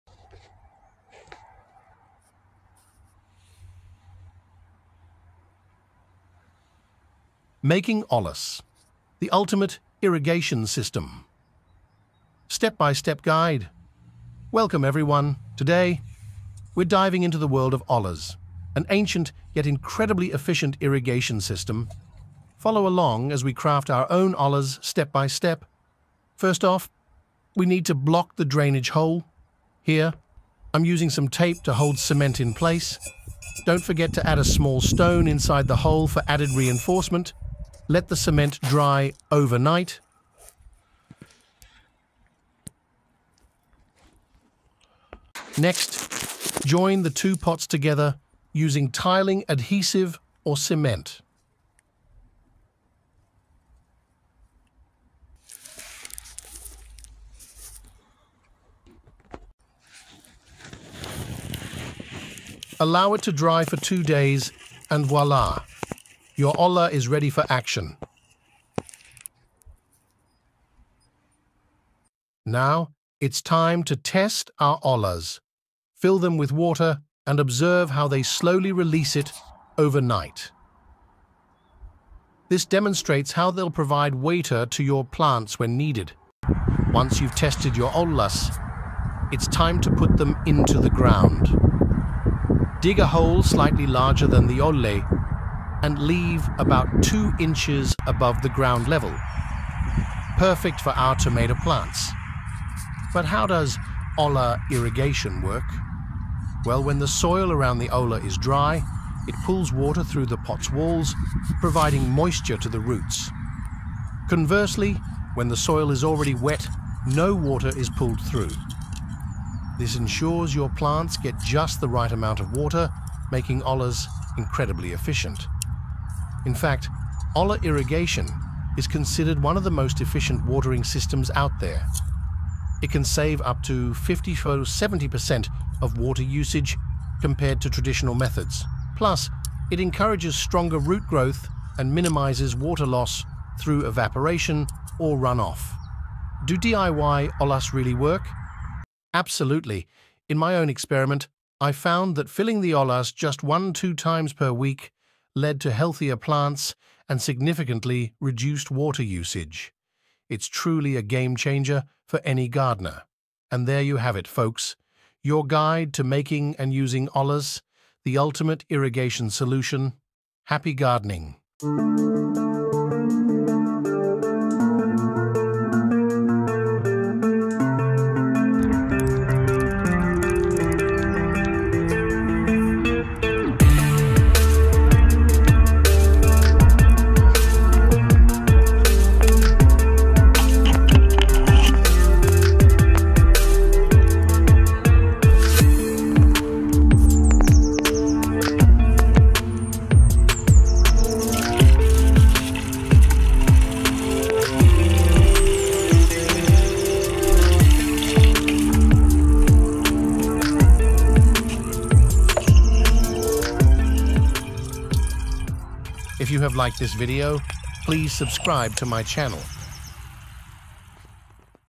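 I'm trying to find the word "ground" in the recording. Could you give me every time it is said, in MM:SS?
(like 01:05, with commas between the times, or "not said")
01:30, 01:38.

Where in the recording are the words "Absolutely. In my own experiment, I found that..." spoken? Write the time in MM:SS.
02:29.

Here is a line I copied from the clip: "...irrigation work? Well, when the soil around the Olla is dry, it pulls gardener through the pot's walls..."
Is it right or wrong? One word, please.
wrong.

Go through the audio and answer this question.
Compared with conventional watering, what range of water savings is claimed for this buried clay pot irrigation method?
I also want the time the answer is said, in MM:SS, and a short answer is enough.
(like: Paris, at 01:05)
50 to 70%, at 02:13.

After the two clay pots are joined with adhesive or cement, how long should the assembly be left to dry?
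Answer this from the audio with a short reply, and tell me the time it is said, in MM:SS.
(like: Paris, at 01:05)
2 days, at 01:03.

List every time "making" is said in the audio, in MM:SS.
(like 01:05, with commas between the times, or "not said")
00:07, 02:03, 02:46.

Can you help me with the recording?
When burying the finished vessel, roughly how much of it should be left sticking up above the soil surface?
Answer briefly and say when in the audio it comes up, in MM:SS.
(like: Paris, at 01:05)
2 inches, at 01:37.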